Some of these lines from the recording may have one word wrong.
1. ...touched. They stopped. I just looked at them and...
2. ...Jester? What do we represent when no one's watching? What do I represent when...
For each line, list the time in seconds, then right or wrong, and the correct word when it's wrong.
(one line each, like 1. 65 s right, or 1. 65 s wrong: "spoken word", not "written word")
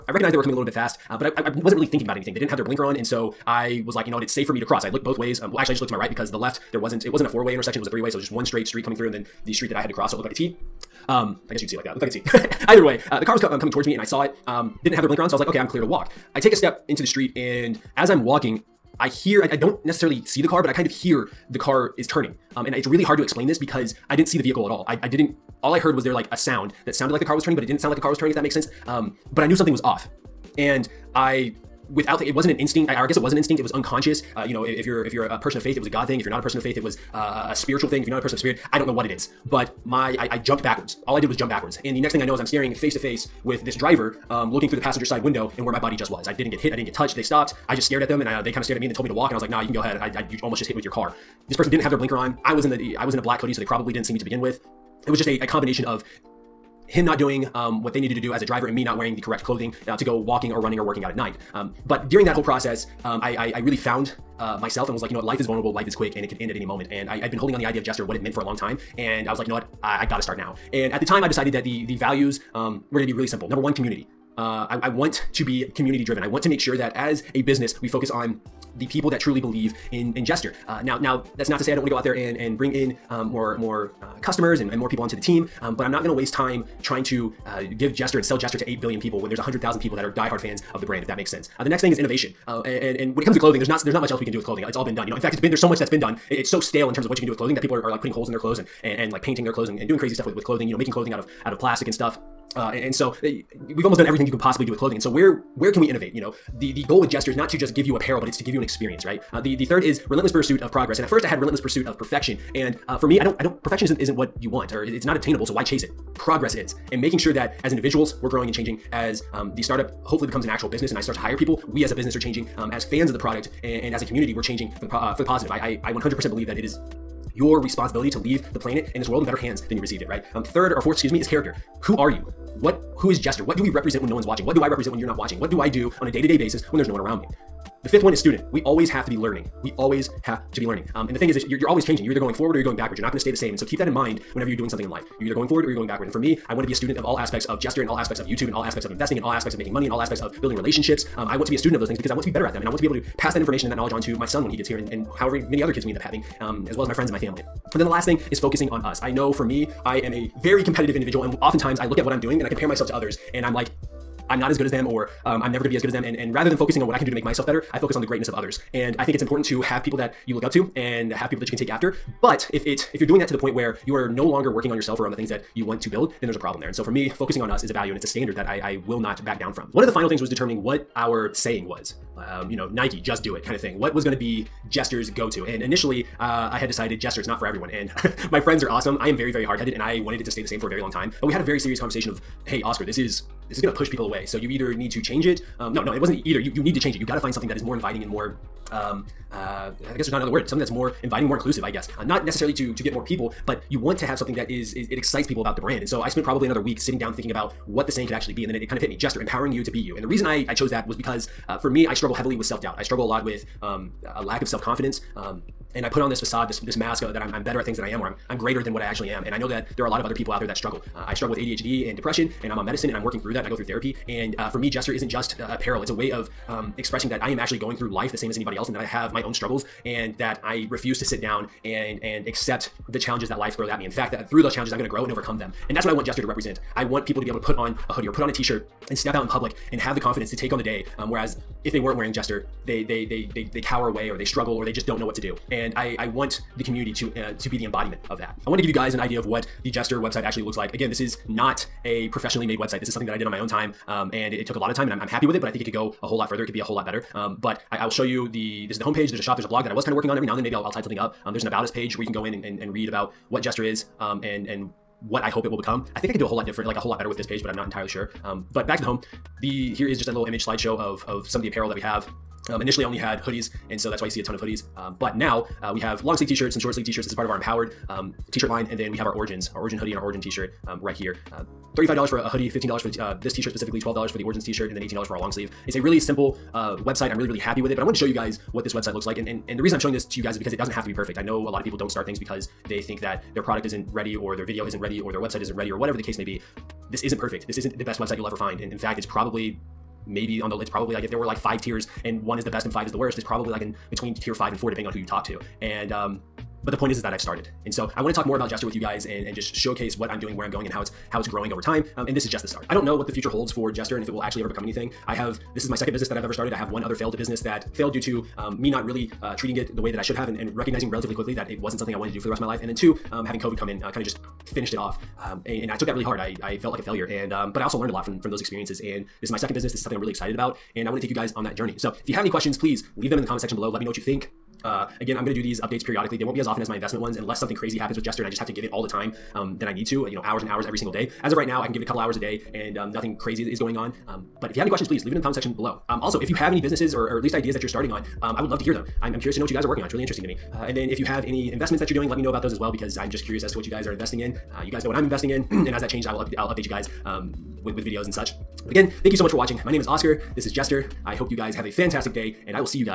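1. 46 s wrong: "stared", not "looked"
2. 133 s right.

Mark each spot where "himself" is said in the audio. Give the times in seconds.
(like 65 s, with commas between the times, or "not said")
not said.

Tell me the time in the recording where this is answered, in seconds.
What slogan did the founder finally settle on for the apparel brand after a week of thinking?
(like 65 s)
208 s.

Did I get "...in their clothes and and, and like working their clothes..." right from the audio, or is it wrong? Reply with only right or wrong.
wrong.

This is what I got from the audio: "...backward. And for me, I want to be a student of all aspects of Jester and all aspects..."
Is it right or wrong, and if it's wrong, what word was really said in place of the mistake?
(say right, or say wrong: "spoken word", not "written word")
right.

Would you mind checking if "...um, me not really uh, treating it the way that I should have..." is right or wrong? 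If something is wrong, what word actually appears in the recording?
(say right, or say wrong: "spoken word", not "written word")
right.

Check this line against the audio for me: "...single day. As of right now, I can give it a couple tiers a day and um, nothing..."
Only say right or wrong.
wrong.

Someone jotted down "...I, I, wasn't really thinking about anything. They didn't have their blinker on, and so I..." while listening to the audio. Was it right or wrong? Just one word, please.
right.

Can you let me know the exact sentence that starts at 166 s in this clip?
And and rather than focusing on what I can do to make myself better, I focus on the greatness of others.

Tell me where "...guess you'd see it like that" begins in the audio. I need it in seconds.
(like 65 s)
11 s.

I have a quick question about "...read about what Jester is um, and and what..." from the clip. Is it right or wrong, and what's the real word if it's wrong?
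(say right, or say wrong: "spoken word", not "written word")
right.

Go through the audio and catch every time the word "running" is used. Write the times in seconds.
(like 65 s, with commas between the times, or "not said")
60 s.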